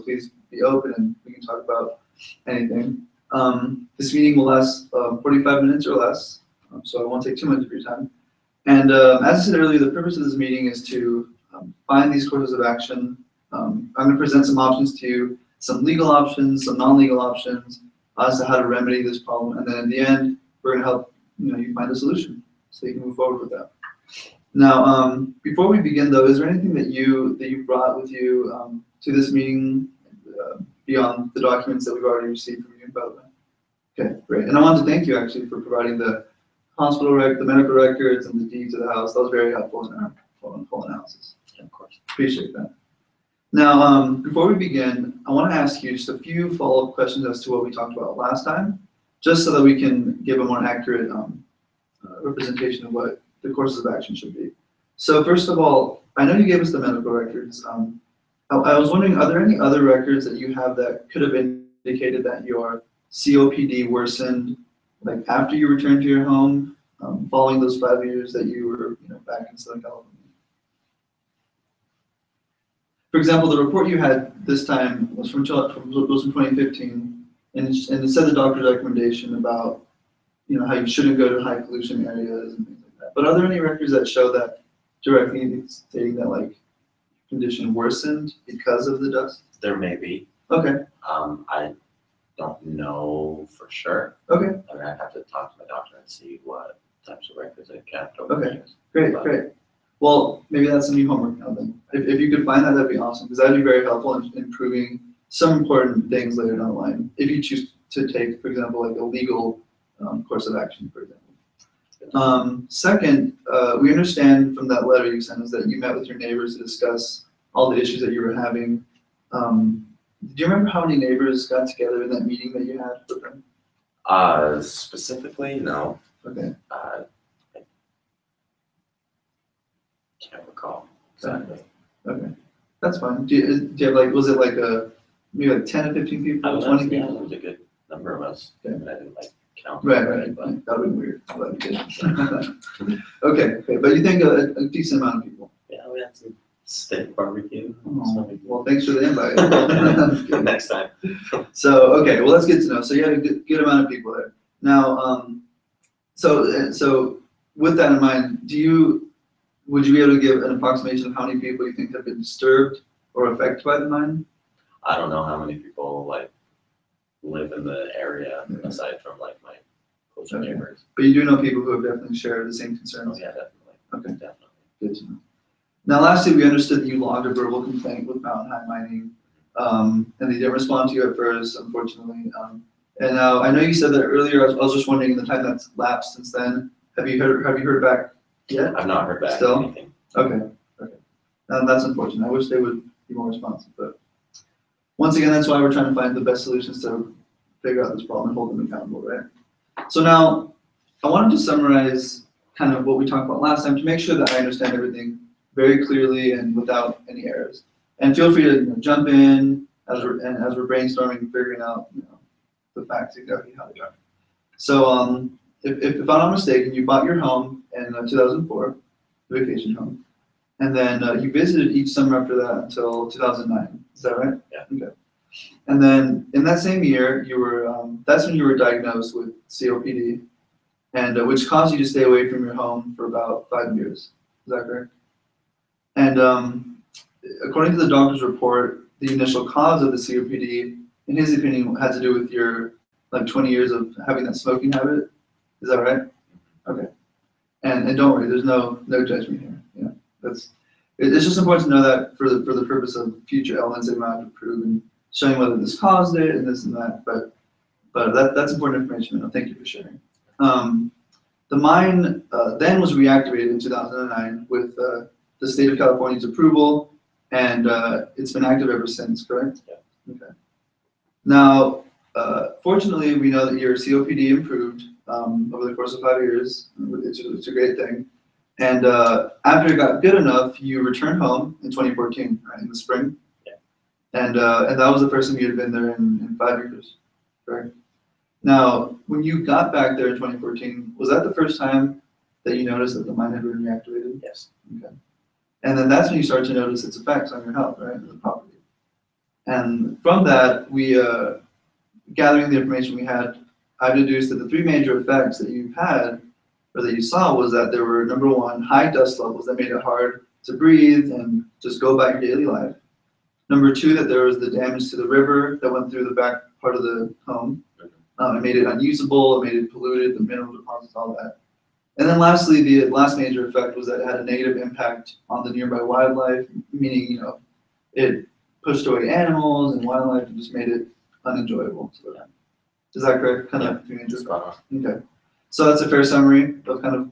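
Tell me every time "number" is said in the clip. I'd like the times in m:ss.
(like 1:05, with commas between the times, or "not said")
2:17, 5:08, 5:13.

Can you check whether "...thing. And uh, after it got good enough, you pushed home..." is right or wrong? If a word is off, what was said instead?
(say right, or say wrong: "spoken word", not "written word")
wrong: "returned", not "pushed".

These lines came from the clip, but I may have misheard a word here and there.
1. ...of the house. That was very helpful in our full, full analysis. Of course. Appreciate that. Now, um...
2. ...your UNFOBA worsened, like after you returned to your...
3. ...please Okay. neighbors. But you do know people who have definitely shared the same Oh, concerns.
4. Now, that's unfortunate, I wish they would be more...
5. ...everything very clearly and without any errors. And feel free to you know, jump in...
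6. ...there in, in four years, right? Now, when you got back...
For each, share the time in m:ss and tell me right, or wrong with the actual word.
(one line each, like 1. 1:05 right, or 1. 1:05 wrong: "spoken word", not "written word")
1. 0:38 right
2. 1:02 wrong: "COPD", not "UNFOBA"
3. 2:50 wrong: "close", not "please"
4. 3:11 right
5. 3:24 right
6. 4:45 wrong: "five", not "four".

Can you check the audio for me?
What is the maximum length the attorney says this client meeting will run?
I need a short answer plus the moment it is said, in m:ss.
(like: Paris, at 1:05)
45 minutes, at 0:05.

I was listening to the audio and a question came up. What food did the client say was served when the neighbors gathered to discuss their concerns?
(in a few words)
Steak barbecue.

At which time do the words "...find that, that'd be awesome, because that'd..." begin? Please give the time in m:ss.
1:42.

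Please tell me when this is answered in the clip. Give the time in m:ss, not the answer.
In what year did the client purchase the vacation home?
3:38.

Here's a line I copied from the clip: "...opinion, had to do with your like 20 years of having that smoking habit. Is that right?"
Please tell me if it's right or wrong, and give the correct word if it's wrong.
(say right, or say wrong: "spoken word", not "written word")
right.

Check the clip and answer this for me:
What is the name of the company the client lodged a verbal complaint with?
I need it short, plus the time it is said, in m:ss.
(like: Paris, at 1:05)
Mountain High Mining, at 2:58.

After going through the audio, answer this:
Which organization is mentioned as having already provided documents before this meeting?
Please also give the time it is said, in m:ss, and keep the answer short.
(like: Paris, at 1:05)
UNFOBA, at 0:32.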